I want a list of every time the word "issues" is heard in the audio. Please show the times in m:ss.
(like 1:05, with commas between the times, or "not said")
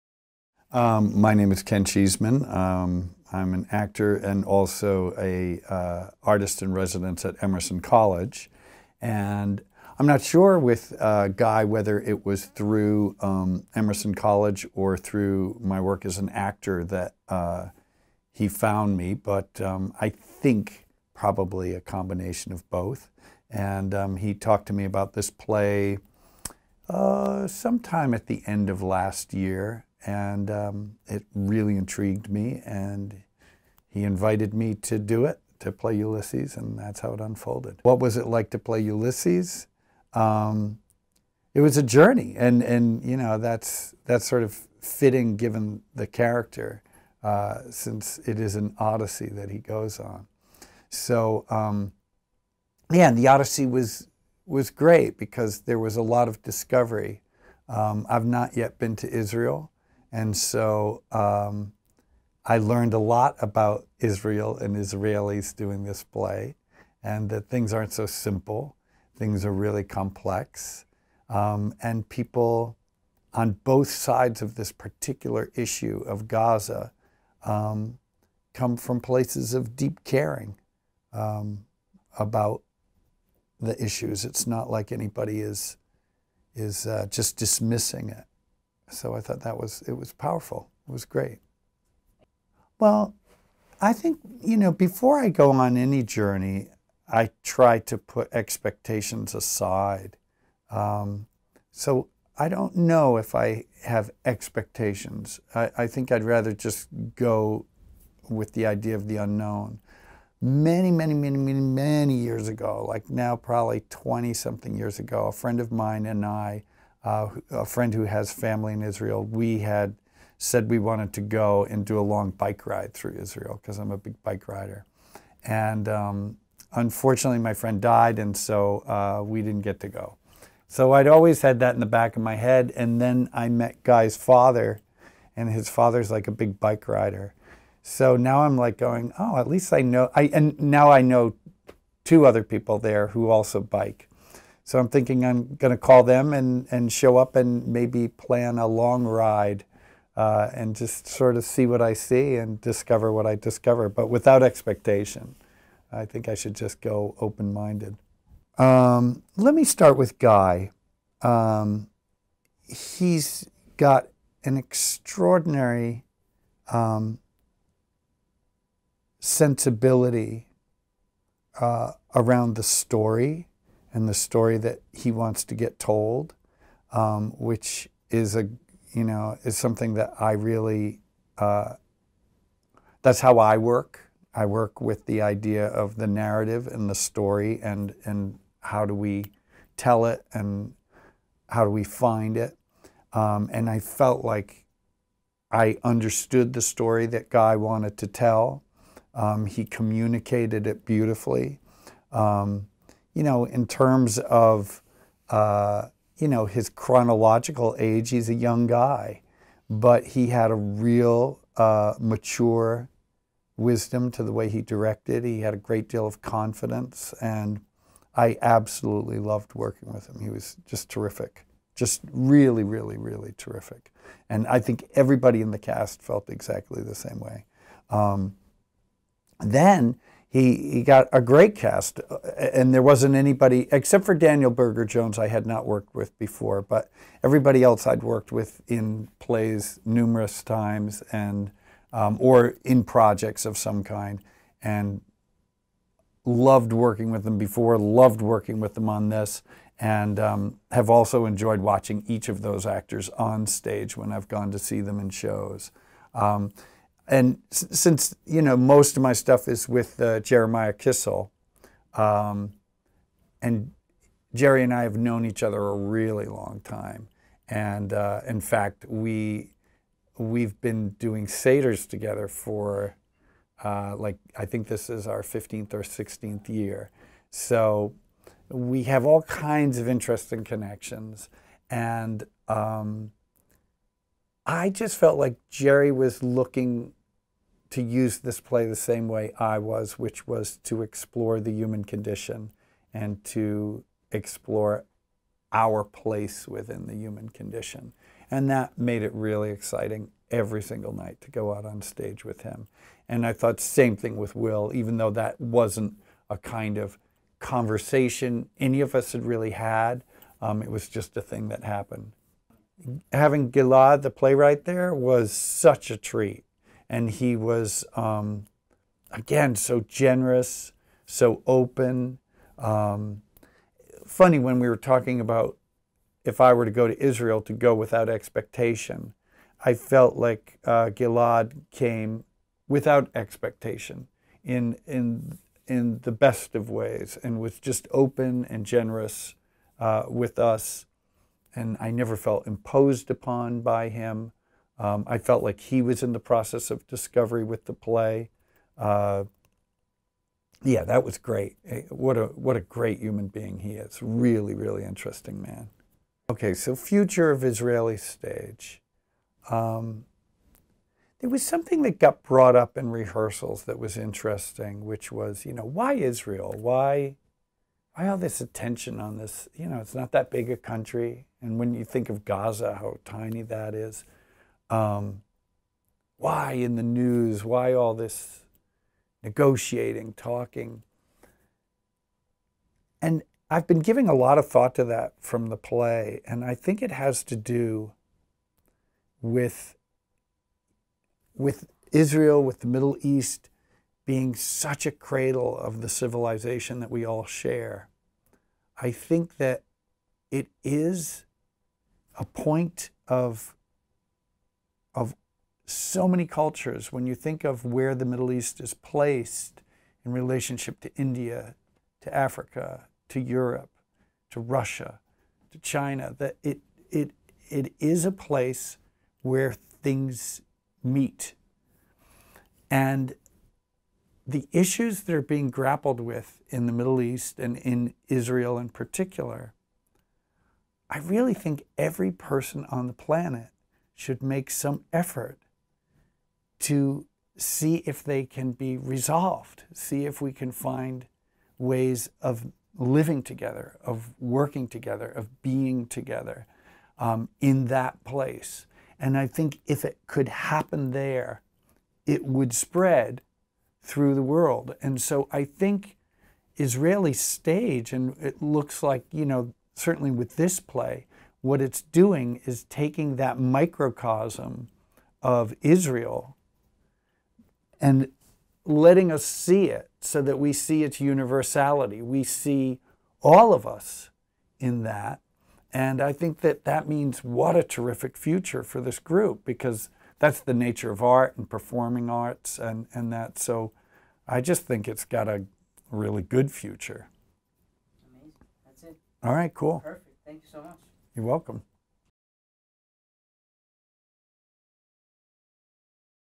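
1:15, 1:23, 7:04.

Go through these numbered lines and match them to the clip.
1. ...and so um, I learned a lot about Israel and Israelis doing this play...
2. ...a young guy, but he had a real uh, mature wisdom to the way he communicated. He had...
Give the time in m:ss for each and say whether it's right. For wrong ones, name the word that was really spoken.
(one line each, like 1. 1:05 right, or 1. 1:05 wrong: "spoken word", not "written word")
1. 1:00 right
2. 3:28 wrong: "directed", not "communicated".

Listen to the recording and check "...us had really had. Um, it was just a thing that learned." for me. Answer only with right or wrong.
wrong.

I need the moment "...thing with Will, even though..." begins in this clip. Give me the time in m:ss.
5:03.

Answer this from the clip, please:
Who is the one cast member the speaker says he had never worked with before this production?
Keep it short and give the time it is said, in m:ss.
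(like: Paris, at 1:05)
Daniel Berger Jones, at 3:54.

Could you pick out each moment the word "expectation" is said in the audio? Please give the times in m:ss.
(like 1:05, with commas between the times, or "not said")
1:38, 1:44, 2:34, 5:28, 5:33.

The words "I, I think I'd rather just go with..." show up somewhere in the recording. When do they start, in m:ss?
1:45.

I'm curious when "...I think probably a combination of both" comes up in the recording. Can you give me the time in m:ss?
0:19.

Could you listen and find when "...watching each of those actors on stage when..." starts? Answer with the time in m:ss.
4:11.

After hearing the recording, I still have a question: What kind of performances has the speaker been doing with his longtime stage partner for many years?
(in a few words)
satyrs.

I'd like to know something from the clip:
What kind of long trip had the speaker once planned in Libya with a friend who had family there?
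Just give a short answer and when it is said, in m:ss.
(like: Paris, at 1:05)
bike ride, at 2:02.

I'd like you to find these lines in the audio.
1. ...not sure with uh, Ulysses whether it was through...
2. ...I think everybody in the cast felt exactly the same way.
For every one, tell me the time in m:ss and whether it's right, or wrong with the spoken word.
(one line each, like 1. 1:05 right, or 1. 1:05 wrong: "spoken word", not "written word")
1. 0:10 wrong: "Guy", not "Ulysses"
2. 3:44 right.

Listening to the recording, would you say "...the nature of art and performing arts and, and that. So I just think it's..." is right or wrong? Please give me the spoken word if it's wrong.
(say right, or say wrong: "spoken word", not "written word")
right.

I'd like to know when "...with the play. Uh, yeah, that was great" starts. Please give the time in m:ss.
5:47.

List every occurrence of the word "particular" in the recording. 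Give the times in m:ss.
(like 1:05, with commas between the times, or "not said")
1:14, 7:08.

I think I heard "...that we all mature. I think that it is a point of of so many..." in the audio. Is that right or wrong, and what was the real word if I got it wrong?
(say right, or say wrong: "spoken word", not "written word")
wrong: "share", not "mature".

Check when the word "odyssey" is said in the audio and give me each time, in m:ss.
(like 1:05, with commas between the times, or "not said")
0:48, 0:53.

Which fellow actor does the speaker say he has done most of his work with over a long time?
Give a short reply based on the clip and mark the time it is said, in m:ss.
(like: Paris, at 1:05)
Jeremiah Kissel, at 4:20.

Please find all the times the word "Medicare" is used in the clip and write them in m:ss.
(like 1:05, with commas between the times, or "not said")
not said.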